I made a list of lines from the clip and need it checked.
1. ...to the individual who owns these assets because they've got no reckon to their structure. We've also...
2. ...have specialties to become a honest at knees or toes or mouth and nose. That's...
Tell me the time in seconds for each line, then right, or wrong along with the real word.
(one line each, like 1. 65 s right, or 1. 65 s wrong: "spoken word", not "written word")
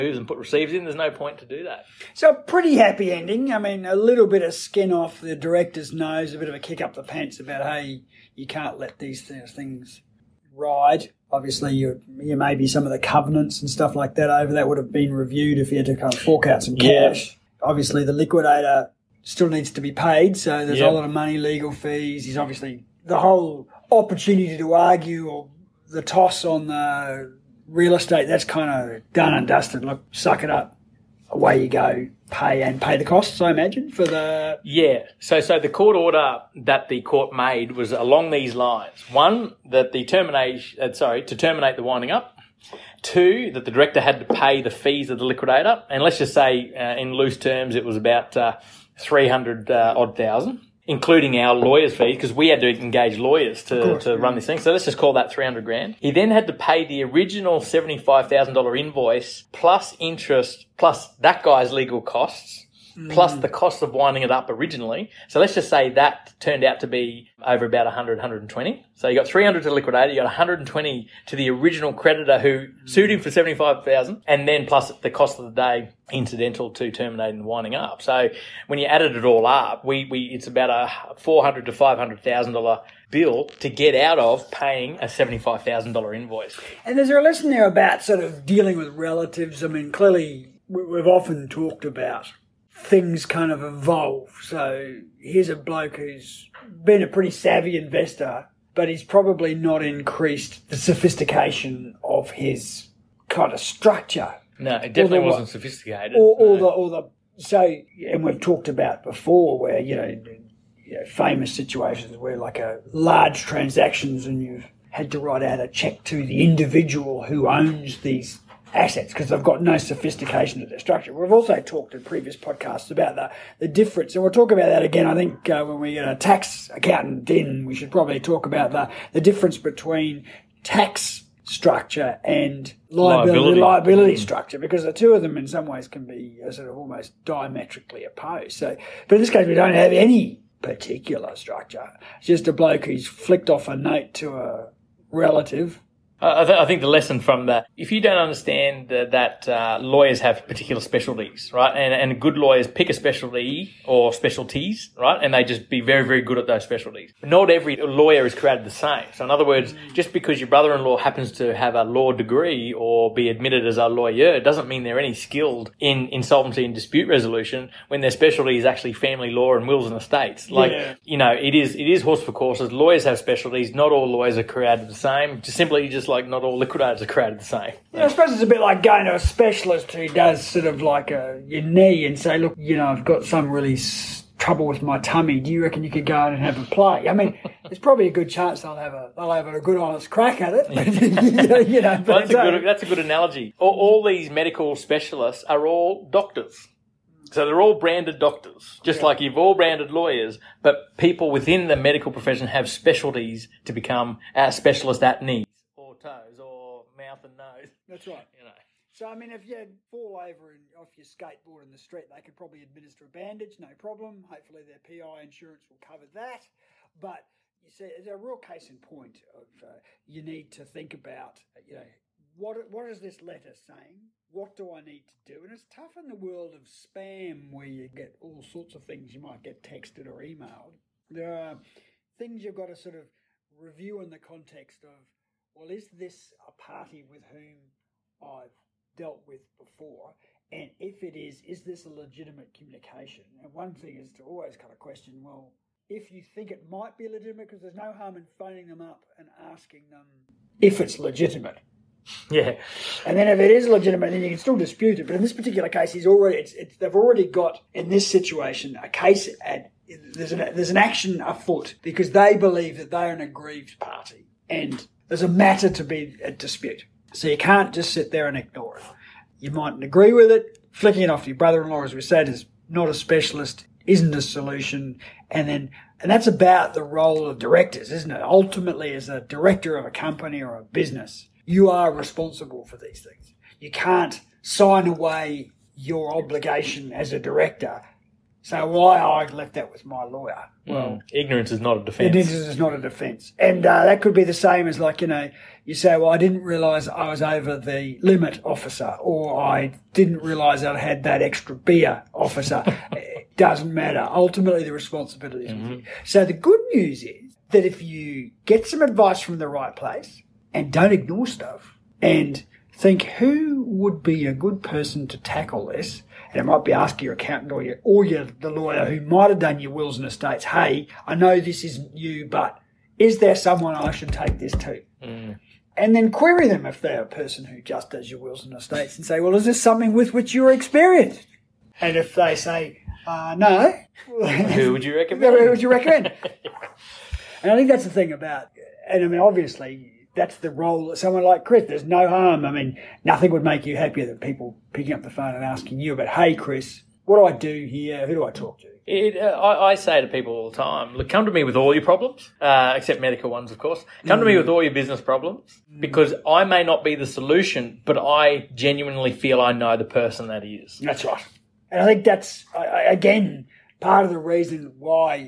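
1. 116 s wrong: "sophistication", not "reckon"
2. 202 s wrong: "specialist", not "honest".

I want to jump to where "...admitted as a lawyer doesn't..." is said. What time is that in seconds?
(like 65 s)
163 s.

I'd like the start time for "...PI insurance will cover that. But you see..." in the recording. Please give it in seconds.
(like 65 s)
214 s.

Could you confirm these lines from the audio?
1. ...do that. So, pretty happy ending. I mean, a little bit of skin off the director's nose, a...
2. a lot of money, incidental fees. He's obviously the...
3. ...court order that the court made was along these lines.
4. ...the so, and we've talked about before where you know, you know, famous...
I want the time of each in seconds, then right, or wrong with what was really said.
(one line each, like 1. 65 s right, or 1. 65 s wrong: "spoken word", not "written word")
1. 1 s right
2. 20 s wrong: "legal", not "incidental"
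3. 35 s right
4. 106 s right.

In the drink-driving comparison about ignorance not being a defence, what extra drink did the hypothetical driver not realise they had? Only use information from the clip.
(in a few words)
beer.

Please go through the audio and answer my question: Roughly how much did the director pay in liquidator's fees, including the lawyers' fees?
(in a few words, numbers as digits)
300 thousand.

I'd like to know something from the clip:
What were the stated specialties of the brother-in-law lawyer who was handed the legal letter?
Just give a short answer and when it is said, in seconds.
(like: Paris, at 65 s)
family law and wills and estates, at 168 s.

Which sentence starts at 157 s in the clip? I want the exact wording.
Not every lawyer is created the same.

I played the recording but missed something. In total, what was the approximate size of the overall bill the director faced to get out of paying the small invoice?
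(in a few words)
400 to 500,000 dollars.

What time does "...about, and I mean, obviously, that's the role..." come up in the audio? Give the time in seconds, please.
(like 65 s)
338 s.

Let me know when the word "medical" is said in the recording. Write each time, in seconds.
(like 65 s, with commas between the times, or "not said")
194 s, 201 s, 353 s.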